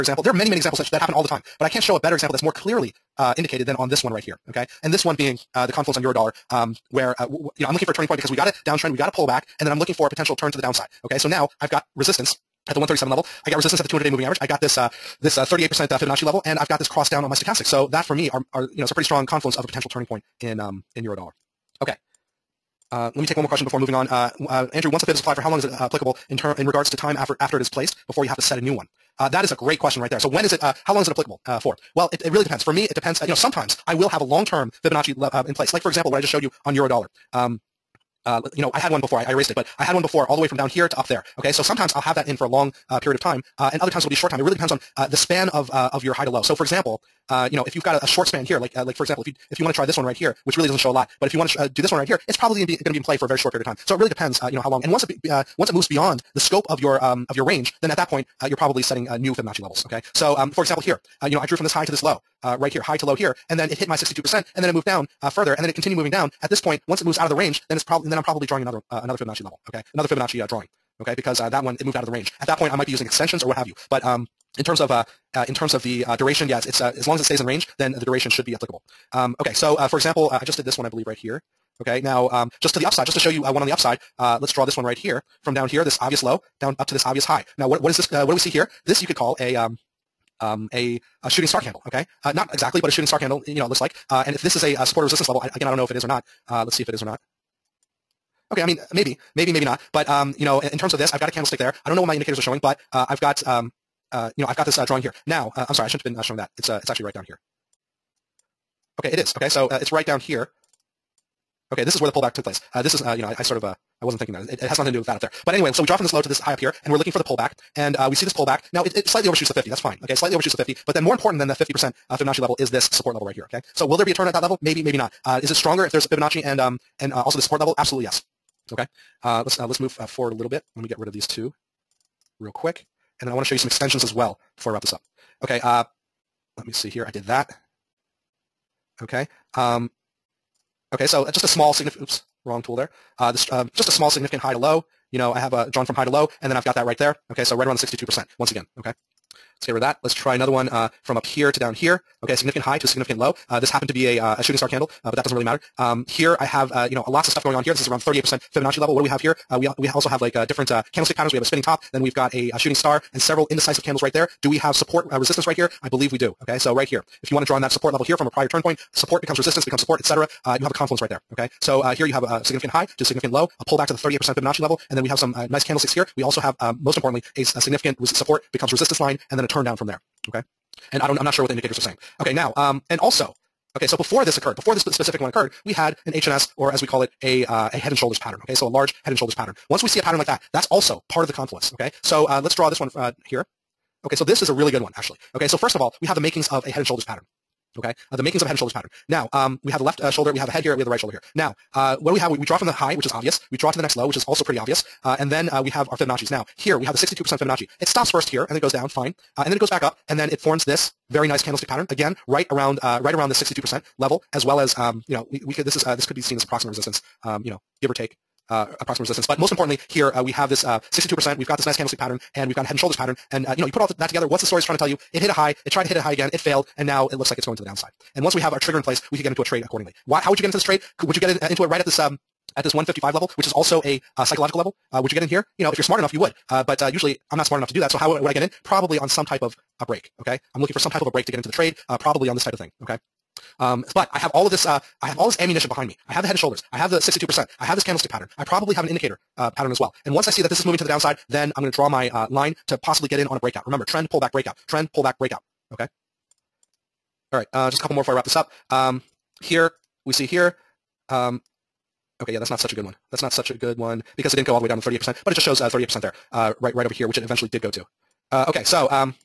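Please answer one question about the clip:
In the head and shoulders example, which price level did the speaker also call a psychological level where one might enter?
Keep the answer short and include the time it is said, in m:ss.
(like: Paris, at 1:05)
155, at 3:52.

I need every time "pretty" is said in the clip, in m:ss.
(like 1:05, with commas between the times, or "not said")
0:18, 3:24.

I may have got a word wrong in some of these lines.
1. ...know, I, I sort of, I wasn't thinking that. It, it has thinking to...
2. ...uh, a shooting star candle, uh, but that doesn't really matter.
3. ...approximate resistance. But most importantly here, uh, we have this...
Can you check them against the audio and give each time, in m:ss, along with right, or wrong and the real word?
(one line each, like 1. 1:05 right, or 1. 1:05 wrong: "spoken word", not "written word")
1. 1:53 wrong: "nothing", not "thinking"
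2. 2:34 right
3. 3:38 right.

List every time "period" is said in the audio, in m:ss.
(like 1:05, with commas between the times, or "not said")
0:42, 0:53.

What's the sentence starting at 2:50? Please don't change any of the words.
Uh, you have a confluence right there.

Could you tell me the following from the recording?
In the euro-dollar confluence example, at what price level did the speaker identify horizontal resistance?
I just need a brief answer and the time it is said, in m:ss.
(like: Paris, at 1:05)
137, at 0:12.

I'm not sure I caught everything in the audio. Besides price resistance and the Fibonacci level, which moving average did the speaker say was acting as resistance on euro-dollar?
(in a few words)
200-day moving average.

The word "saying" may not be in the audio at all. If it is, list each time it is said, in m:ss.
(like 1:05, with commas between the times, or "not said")
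3:01.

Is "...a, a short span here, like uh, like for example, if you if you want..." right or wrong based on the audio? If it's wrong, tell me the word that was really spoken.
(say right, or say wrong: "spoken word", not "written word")
right.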